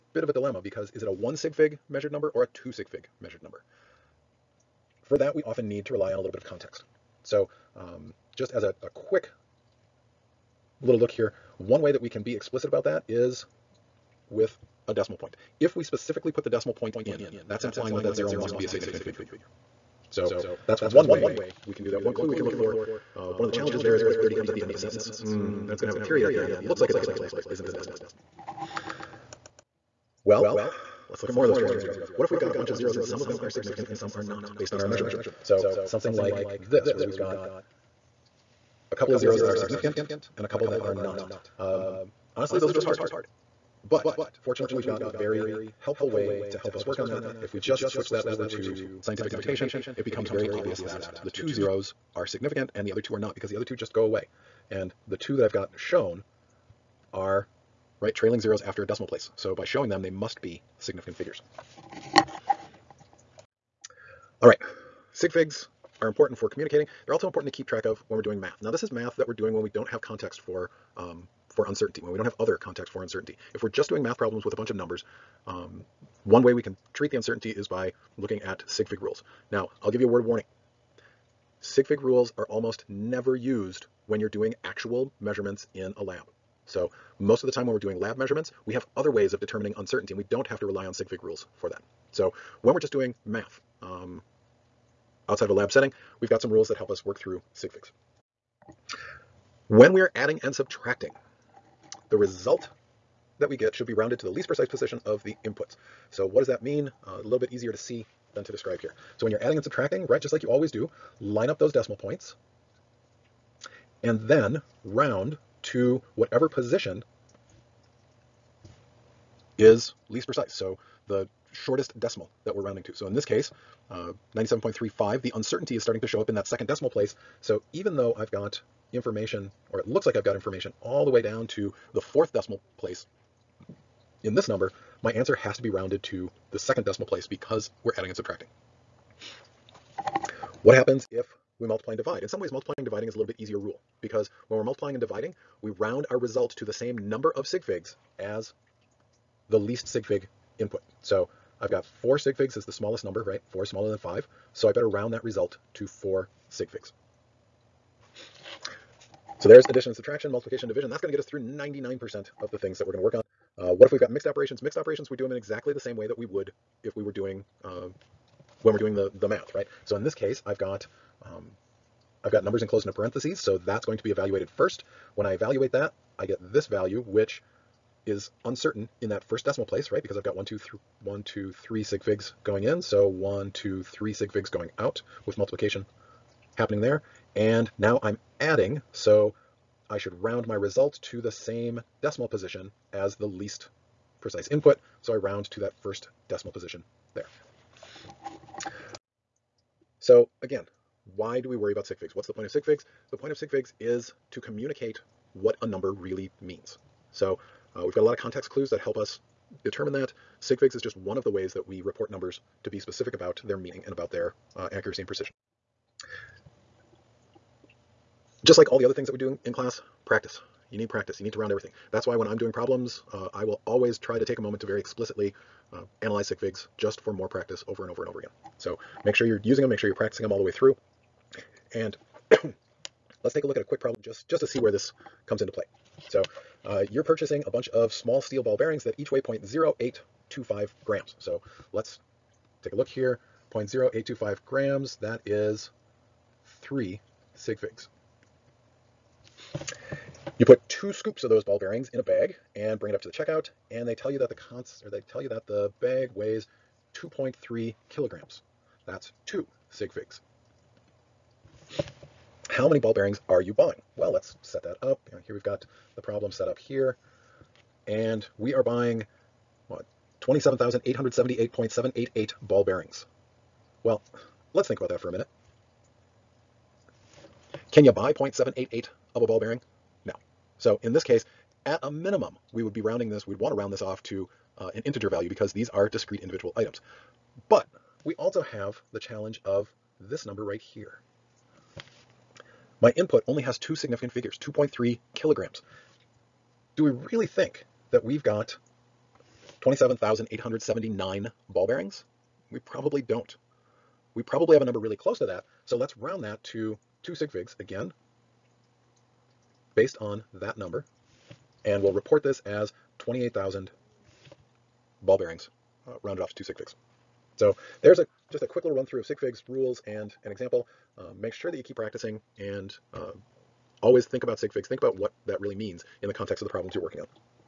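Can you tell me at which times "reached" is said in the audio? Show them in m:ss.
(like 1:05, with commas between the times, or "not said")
not said.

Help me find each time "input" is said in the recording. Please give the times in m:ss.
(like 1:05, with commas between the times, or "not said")
1:45, 2:30, 3:14, 4:52.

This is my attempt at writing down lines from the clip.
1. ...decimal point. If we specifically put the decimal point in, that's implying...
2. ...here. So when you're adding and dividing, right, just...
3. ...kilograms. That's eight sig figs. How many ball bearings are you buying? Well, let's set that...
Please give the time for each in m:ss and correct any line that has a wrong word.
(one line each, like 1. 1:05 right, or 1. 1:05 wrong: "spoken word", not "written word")
1. 0:14 right
2. 1:48 wrong: "subtracting", not "dividing"
3. 4:17 wrong: "two", not "eight".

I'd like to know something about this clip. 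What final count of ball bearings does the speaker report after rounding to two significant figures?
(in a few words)
28,000.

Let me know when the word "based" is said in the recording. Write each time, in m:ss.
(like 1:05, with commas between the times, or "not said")
0:34, 5:09.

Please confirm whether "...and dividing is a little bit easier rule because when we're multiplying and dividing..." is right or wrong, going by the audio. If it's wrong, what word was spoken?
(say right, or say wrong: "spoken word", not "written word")
right.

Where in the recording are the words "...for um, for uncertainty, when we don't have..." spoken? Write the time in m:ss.
1:10.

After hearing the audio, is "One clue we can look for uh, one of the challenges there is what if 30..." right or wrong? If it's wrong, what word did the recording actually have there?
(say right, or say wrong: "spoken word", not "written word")
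right.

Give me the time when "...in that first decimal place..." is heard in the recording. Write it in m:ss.
2:59.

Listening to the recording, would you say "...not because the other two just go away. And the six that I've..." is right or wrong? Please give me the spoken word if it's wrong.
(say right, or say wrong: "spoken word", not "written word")
wrong: "two", not "six".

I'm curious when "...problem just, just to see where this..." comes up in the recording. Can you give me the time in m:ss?
3:53.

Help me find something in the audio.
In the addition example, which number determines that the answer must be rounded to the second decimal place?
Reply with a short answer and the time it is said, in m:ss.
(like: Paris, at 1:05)
97.35, at 2:04.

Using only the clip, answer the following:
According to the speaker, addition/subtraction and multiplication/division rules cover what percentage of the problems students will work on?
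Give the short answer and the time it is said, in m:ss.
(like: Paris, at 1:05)
99%, at 2:41.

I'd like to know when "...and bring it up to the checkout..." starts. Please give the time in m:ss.
4:12.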